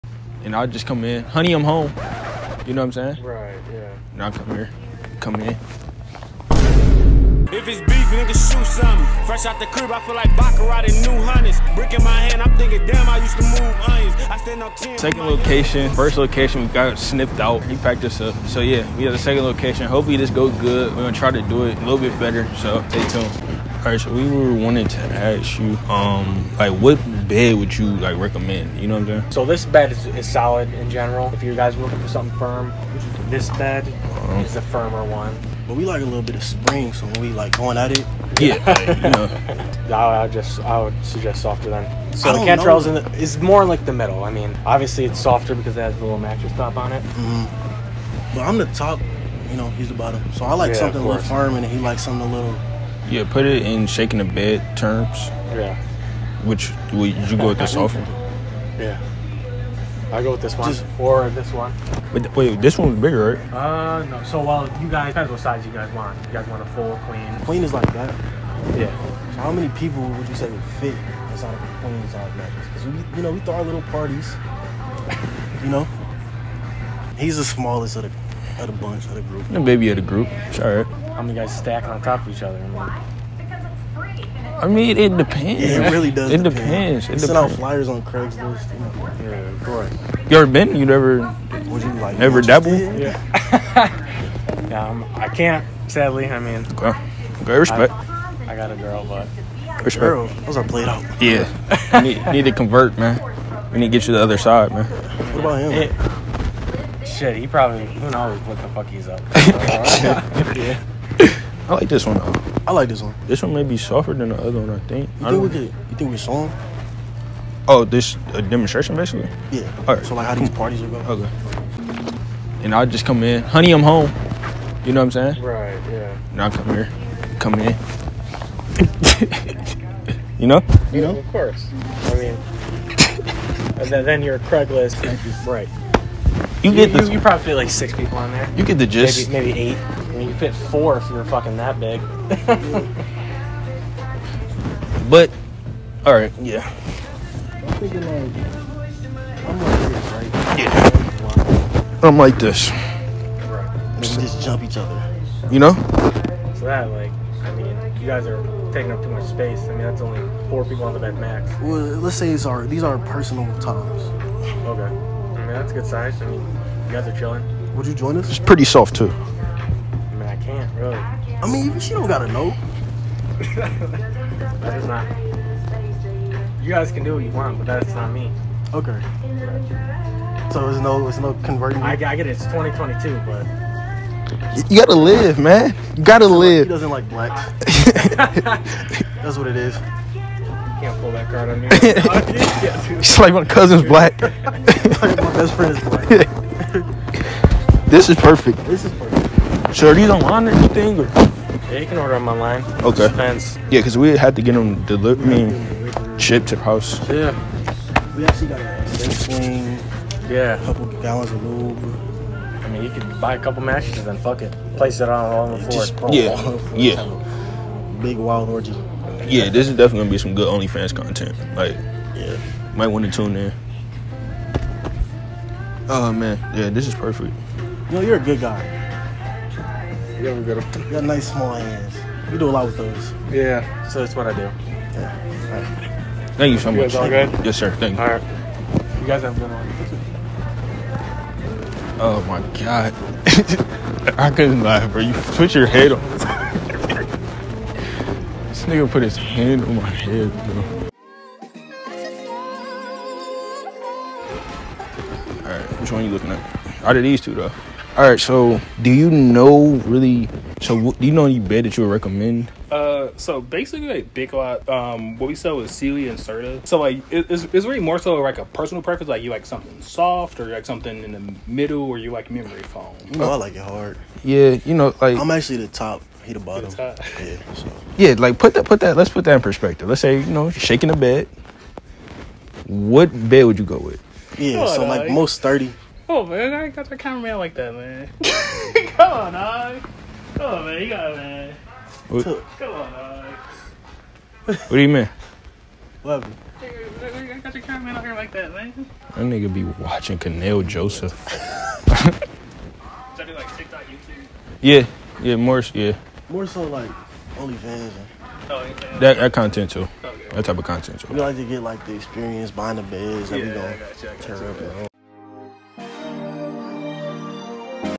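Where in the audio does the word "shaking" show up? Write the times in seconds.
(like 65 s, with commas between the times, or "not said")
53 s, 280 s.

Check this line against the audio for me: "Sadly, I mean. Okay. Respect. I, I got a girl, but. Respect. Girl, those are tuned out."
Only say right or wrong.
wrong.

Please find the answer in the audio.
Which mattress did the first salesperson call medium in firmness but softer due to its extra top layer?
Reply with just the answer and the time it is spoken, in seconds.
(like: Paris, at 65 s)
Cantrell, at 42 s.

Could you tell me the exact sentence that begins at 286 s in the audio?
Oh man, I got that cameraman like that, man.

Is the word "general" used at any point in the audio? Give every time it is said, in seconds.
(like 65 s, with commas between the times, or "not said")
30 s.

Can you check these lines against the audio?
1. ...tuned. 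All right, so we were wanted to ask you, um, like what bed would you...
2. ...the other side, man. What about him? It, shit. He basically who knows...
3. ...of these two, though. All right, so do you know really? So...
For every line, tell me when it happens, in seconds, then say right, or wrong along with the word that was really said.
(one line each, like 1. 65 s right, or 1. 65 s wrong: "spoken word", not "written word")
1. 23 s right
2. 104 s wrong: "probably", not "basically"
3. 256 s right.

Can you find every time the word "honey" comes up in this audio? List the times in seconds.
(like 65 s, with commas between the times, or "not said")
1 s, 123 s.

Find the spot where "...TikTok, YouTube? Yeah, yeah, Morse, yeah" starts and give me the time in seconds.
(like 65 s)
303 s.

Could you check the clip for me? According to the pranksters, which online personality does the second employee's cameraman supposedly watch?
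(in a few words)
Kanel Joseph.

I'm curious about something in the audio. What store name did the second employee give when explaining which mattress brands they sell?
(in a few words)
Big Lot.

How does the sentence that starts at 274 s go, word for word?
Yeah, you know, like I'm actually the top he the bottom.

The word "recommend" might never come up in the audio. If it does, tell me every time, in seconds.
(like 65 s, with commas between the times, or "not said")
28 s, 261 s.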